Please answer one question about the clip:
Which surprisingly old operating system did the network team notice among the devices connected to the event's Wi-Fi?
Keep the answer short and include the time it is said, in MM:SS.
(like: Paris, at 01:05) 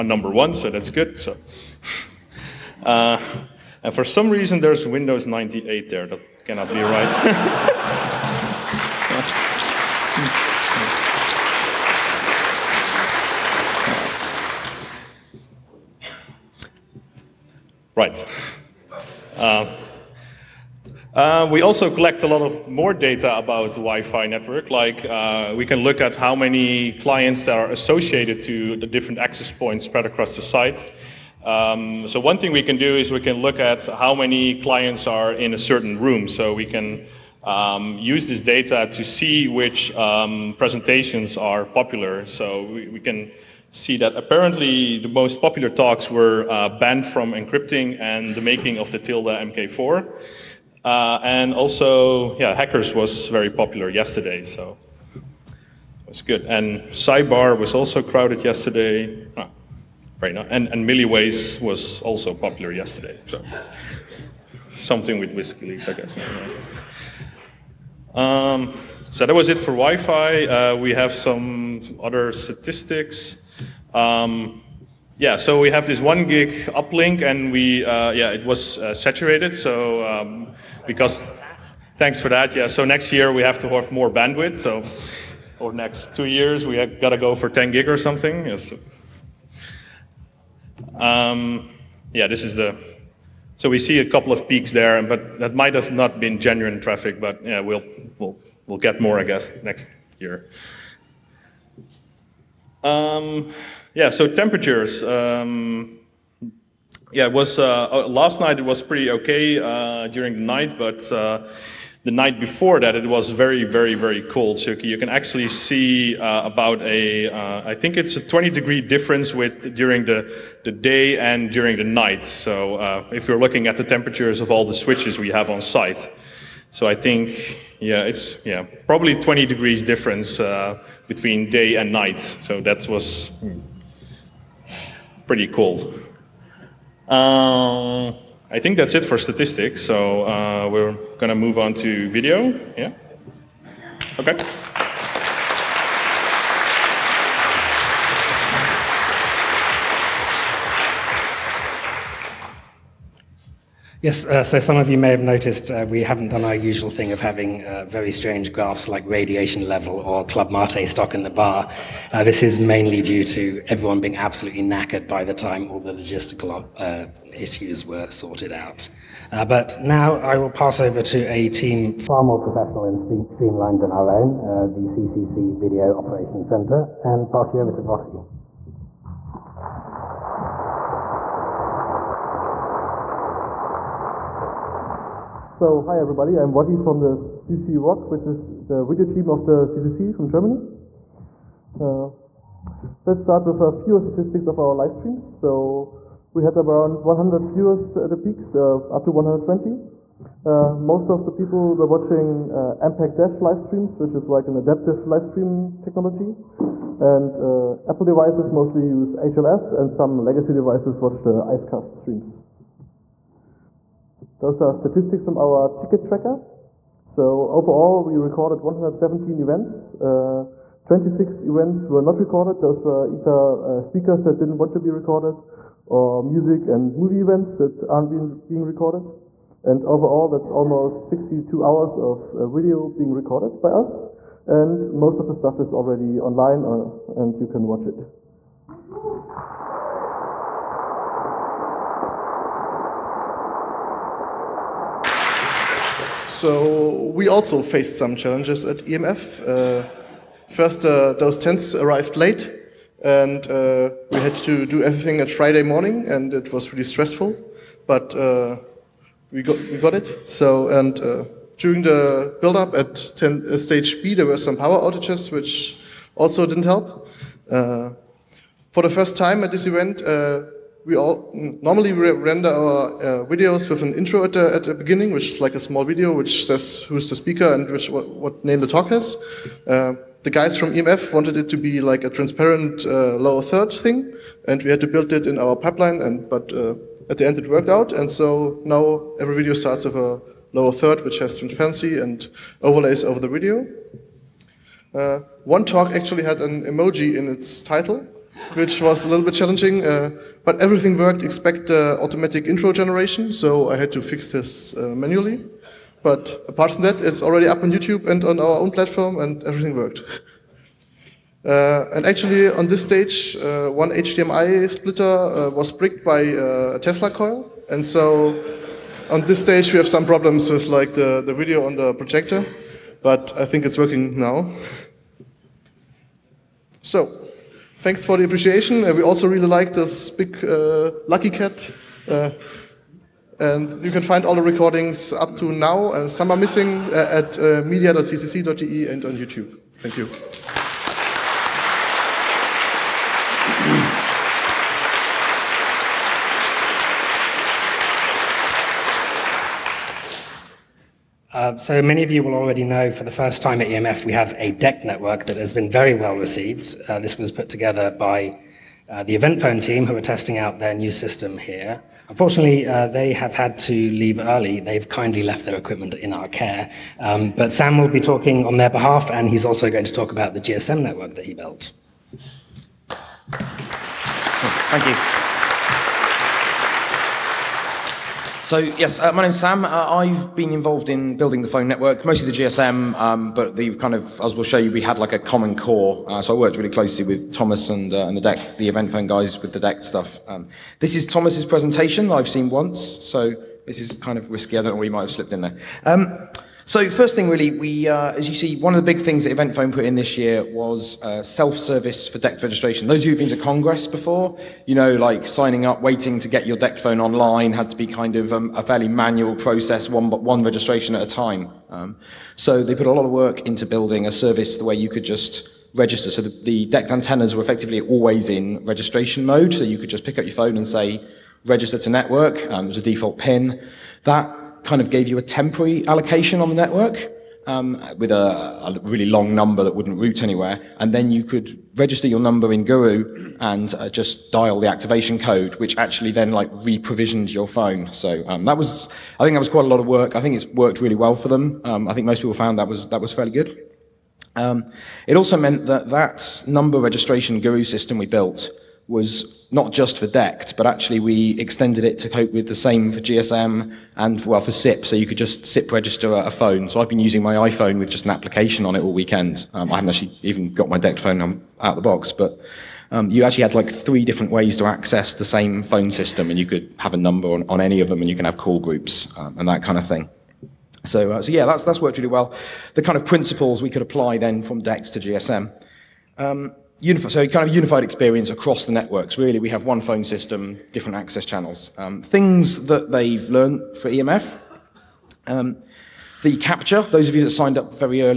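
Windows 98, at 00:04.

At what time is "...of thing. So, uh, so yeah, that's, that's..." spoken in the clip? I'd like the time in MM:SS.
07:49.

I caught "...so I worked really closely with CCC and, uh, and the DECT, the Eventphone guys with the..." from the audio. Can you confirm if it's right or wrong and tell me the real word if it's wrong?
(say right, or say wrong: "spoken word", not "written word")
wrong: "Thomas", not "CCC".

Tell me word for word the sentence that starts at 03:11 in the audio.
Uh, let's start with a few statistics of our live streams.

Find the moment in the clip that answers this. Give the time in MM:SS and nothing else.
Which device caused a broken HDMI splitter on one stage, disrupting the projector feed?
05:16.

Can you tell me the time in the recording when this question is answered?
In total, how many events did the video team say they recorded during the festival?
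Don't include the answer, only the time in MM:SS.
03:38.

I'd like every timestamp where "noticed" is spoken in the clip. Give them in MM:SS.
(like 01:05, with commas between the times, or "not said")
02:35.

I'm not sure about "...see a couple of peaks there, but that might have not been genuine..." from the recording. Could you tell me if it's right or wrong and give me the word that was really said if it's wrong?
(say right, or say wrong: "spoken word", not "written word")
right.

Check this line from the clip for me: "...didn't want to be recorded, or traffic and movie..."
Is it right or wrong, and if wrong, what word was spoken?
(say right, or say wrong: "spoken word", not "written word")
wrong: "music", not "traffic".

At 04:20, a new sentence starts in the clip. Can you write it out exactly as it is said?
So and during the build-up at ten, uh, stage B, there were some power outages, which also didn't help.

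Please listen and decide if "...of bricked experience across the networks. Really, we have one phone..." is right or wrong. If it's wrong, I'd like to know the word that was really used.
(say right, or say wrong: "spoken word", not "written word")
wrong: "unified", not "bricked".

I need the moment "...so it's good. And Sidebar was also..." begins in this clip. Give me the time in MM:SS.
00:54.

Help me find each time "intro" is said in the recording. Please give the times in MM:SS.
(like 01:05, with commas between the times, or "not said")
04:33, 05:02.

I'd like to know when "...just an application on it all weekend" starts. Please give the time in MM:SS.
07:37.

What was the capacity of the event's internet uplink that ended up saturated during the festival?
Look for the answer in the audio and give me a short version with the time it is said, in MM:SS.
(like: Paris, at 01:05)
1 gig, at 01:15.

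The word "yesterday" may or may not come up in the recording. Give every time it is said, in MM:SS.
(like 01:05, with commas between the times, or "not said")
00:53, 00:58, 01:02.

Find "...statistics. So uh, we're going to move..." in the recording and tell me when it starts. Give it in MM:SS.
02:19.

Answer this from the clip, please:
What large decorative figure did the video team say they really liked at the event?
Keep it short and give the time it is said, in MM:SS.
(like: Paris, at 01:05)
Lucky Cat, at 05:31.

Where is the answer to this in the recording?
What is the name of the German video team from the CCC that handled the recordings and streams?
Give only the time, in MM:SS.
03:07.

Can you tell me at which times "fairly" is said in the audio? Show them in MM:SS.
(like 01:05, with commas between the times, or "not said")
06:48, 07:23.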